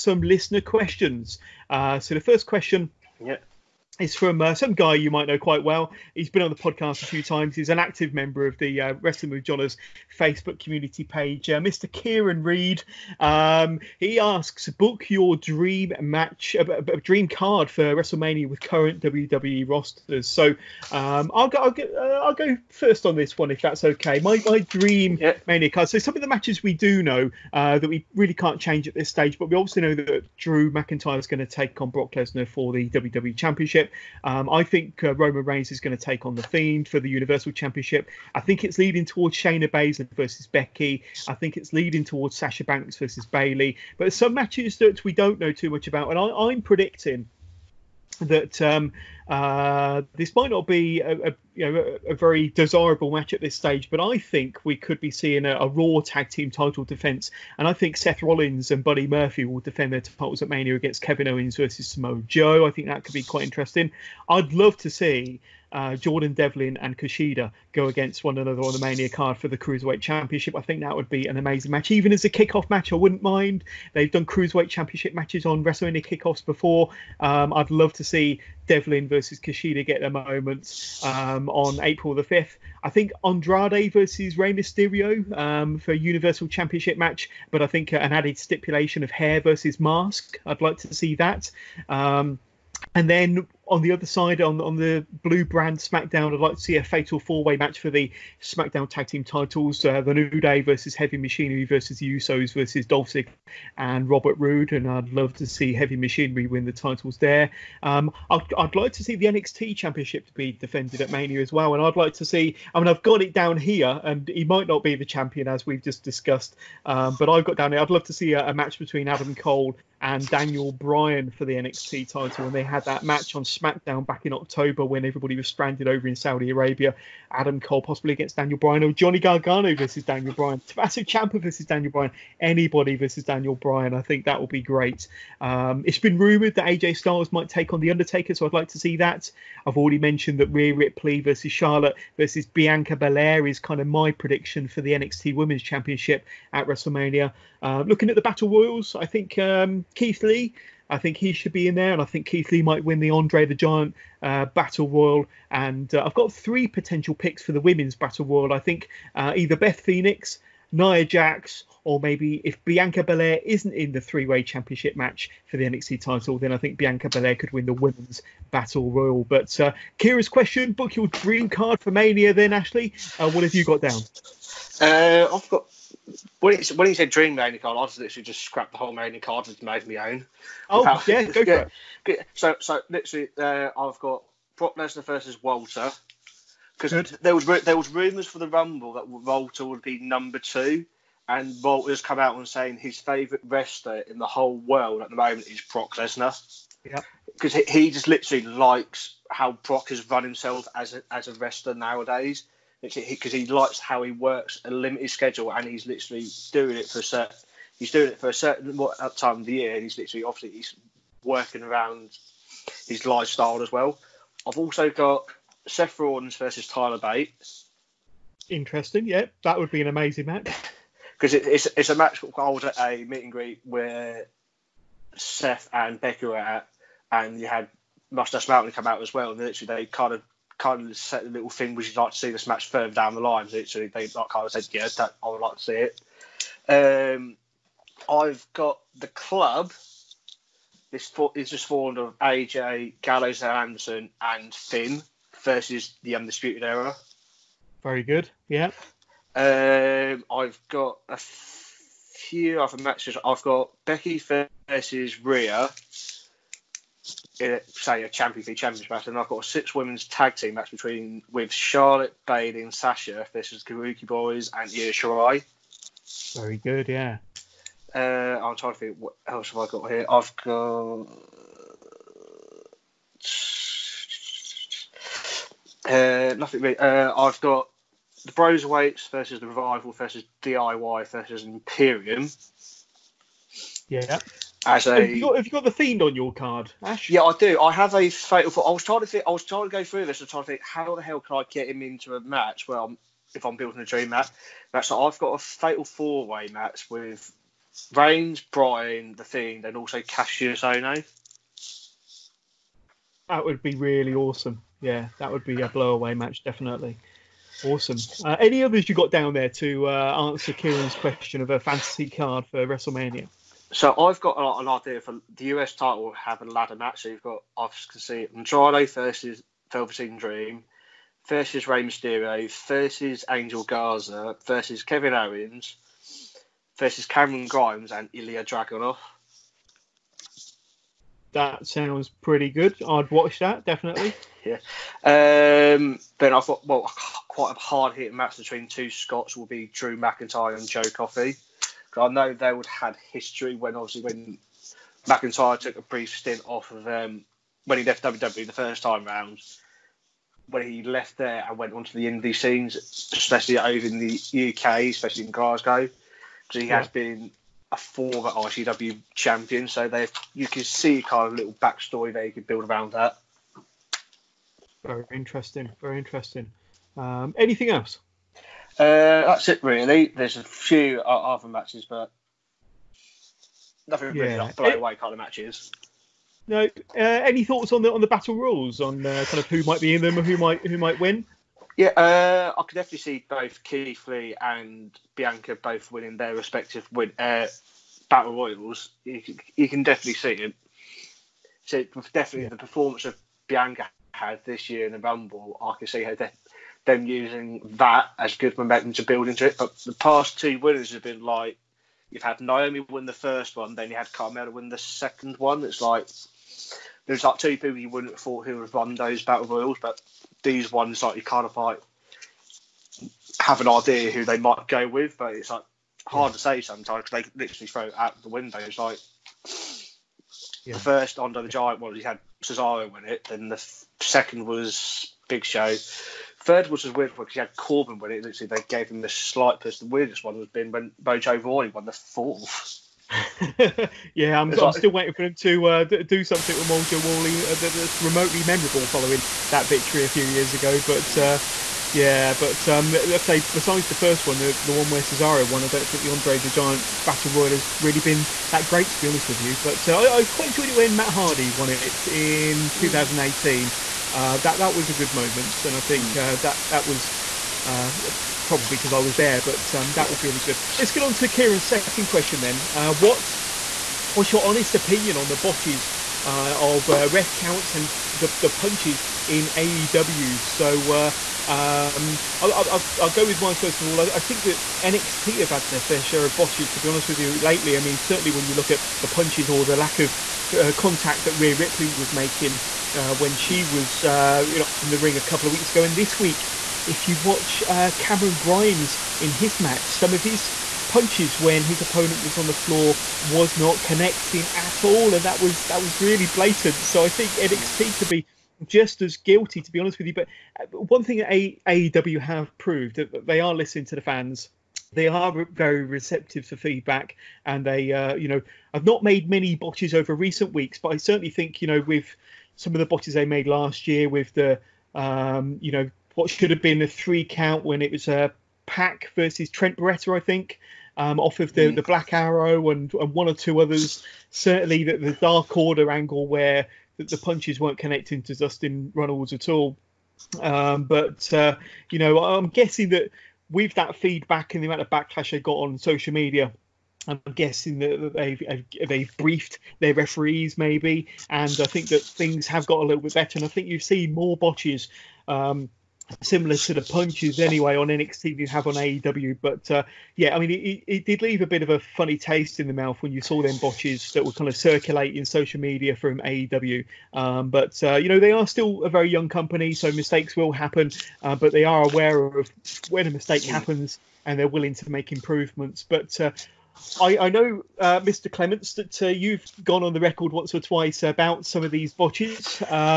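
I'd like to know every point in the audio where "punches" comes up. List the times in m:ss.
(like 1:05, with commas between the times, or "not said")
7:48, 7:59, 8:10, 8:47, 9:06.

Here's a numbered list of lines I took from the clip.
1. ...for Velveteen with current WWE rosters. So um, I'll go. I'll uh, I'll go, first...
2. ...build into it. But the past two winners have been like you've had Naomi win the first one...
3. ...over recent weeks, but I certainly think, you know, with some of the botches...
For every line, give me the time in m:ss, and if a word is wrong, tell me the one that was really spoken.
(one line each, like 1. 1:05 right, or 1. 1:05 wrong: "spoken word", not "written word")
1. 0:17 wrong: "WrestleMania", not "Velveteen"
2. 6:39 right
3. 8:29 right.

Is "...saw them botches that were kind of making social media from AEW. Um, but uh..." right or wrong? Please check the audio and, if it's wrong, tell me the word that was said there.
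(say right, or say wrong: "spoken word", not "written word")
wrong: "circulating", not "making".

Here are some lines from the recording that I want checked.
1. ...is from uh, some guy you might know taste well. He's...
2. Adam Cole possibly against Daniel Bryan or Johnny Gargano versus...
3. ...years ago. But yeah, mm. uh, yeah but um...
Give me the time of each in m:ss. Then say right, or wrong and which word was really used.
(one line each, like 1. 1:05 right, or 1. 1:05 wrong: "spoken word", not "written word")
1. 0:03 wrong: "quite", not "taste"
2. 2:07 right
3. 7:20 right.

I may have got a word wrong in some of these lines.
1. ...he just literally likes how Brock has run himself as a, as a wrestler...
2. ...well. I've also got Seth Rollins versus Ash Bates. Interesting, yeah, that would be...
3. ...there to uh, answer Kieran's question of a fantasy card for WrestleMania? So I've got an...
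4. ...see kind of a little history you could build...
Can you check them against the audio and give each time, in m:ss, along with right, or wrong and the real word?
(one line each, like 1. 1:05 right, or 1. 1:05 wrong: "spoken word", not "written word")
1. 3:17 right
2. 3:33 wrong: "Tyler", not "Ash"
3. 5:09 right
4. 6:00 wrong: "backstory", not "history".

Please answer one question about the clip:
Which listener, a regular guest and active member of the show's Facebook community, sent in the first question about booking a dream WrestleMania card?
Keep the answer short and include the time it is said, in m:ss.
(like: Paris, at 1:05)
Kieran Reed, at 0:11.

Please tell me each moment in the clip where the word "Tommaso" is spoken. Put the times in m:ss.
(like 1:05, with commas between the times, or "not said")
2:10.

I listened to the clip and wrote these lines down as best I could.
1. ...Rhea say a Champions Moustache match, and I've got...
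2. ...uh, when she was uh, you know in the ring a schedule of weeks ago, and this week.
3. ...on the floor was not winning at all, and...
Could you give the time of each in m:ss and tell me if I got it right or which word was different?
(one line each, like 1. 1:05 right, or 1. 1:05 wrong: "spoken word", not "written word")
1. 4:15 wrong: "League", not "Moustache"
2. 8:02 wrong: "couple", not "schedule"
3. 8:12 wrong: "connecting", not "winning".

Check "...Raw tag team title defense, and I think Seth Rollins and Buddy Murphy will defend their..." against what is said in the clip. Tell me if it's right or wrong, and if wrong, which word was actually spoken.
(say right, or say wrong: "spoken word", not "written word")
right.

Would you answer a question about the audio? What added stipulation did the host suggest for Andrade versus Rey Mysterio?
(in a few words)
hair versus mask.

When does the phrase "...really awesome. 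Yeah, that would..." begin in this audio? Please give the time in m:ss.
5:03.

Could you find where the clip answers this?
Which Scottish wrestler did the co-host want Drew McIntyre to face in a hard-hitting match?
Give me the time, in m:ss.
5:40.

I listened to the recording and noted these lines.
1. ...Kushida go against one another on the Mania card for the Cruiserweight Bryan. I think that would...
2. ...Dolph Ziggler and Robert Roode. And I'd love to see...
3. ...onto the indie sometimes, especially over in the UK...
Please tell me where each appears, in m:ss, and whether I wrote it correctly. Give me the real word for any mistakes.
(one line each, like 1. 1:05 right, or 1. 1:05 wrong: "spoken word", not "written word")
1. 1:06 wrong: "Championship", not "Bryan"
2. 1:42 right
3. 5:51 wrong: "scenes", not "sometimes".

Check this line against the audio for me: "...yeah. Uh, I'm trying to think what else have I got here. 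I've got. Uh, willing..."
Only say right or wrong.
wrong.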